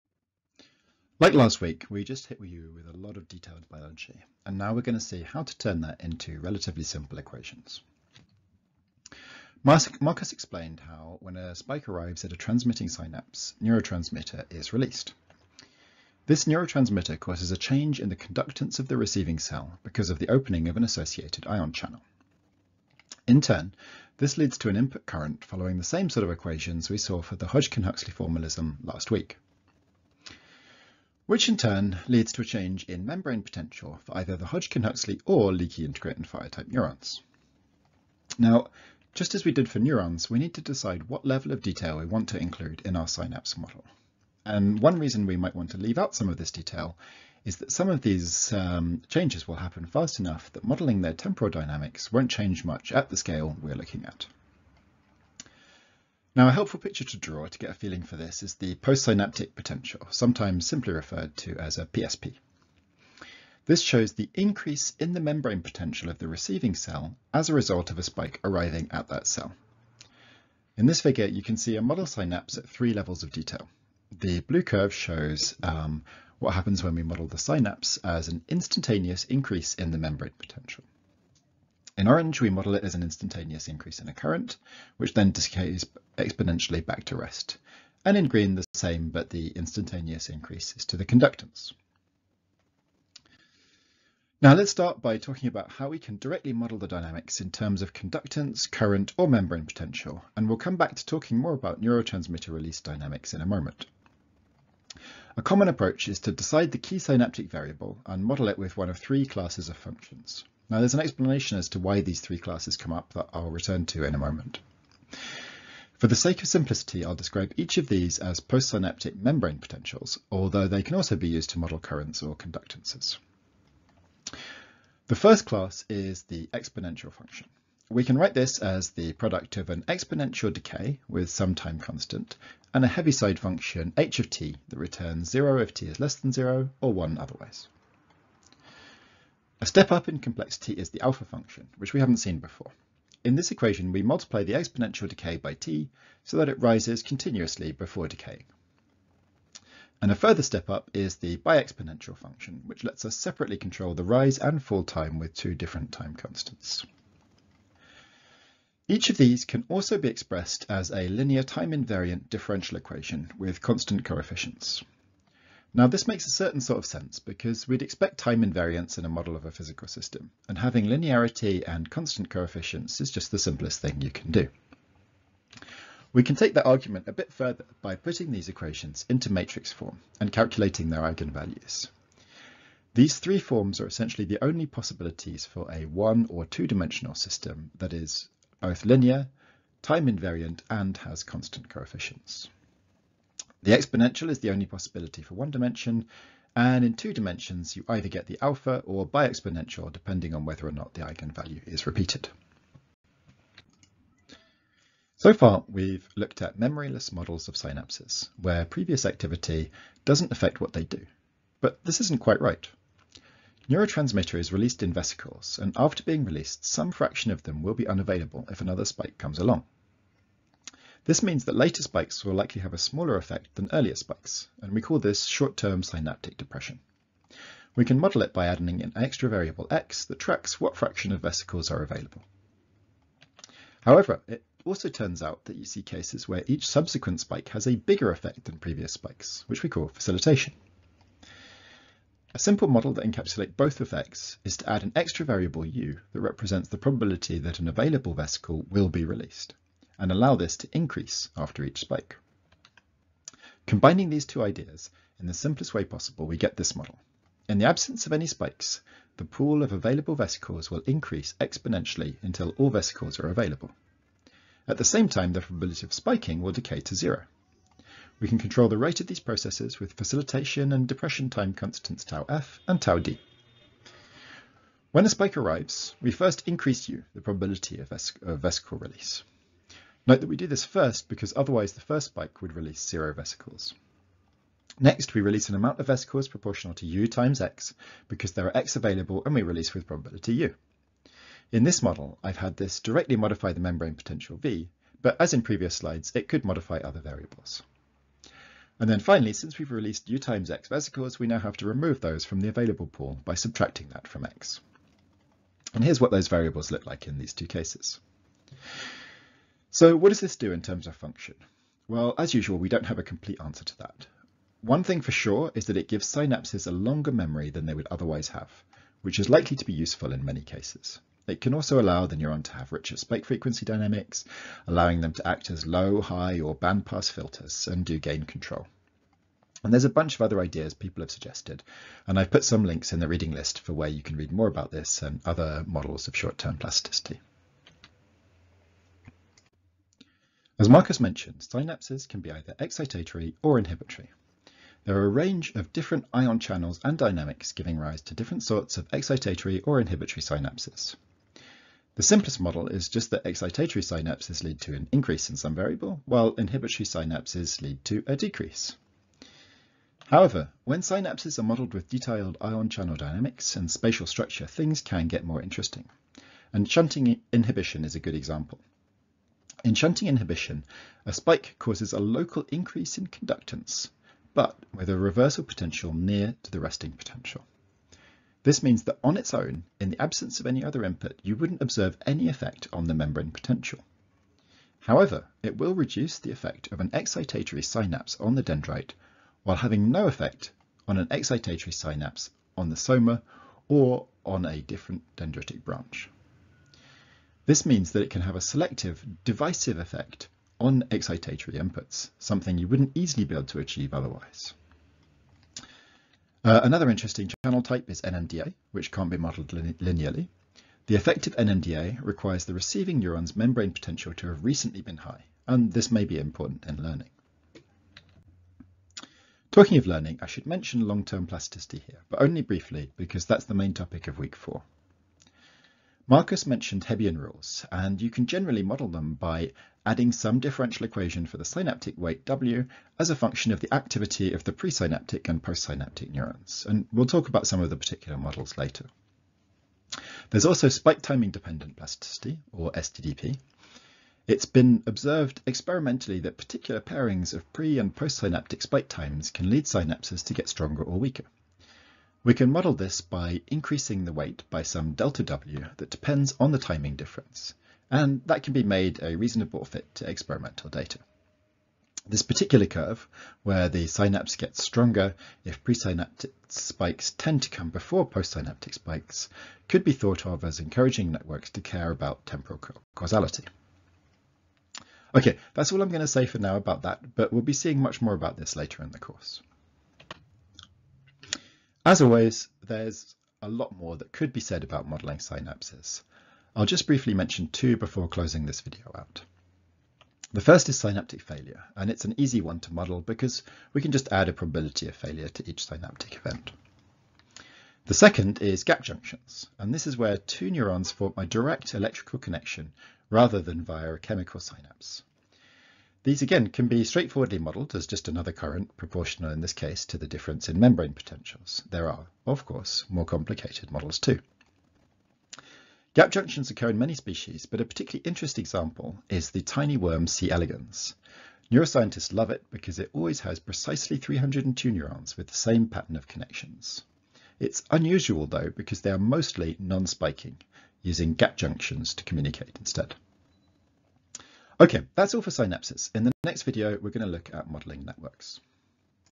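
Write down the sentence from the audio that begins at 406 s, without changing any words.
Uh, another interesting channel type is NMDA, which can't be modeled lin linearly.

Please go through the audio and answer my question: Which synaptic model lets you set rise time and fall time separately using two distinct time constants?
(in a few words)
biexponential function.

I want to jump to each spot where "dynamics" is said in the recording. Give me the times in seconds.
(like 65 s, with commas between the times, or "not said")
51 s, 96 s, 102 s, 323 s, 346 s, 362 s.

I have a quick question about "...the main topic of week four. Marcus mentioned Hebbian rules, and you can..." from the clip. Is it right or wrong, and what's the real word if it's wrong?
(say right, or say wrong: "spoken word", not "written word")
right.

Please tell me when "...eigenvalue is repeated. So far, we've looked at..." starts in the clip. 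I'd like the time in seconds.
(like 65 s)
201 s.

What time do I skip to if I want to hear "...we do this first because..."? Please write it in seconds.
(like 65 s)
280 s.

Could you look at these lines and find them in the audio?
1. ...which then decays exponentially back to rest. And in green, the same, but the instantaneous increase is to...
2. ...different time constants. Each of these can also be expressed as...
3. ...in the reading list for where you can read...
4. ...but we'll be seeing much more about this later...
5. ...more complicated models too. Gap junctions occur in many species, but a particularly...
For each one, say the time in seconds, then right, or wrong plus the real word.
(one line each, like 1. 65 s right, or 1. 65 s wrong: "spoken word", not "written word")
1. 84 s right
2. 155 s right
3. 332 s right
4. 477 s right
5. 512 s right.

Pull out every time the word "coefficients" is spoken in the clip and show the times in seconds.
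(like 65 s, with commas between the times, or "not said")
164 s, 172 s, 191 s.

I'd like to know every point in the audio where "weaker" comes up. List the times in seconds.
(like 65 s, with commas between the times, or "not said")
450 s.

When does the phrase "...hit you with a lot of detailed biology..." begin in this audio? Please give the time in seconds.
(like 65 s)
2 s.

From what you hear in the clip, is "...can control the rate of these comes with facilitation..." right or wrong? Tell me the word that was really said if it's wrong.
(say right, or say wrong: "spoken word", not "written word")
wrong: "processes", not "comes".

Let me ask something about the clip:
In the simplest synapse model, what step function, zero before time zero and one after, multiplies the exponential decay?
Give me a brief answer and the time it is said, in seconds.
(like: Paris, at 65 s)
Heaviside function, at 132 s.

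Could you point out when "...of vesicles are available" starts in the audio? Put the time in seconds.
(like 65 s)
231 s.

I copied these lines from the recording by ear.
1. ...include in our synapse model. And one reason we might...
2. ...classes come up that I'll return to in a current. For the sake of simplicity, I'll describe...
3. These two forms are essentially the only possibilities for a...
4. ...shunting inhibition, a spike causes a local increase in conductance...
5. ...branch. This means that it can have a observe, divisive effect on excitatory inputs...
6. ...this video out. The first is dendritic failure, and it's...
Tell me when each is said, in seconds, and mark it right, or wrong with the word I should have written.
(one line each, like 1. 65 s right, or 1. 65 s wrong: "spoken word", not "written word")
1. 42 s right
2. 112 s wrong: "moment", not "current"
3. 182 s wrong: "three", not "two"
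4. 369 s right
5. 395 s wrong: "selective", not "observe"
6. 488 s wrong: "synaptic", not "dendritic".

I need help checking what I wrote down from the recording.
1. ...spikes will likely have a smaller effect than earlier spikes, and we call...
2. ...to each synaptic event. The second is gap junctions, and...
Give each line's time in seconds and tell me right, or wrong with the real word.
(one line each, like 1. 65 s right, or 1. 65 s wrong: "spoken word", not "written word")
1. 221 s right
2. 495 s right.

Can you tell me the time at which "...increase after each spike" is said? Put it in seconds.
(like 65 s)
250 s.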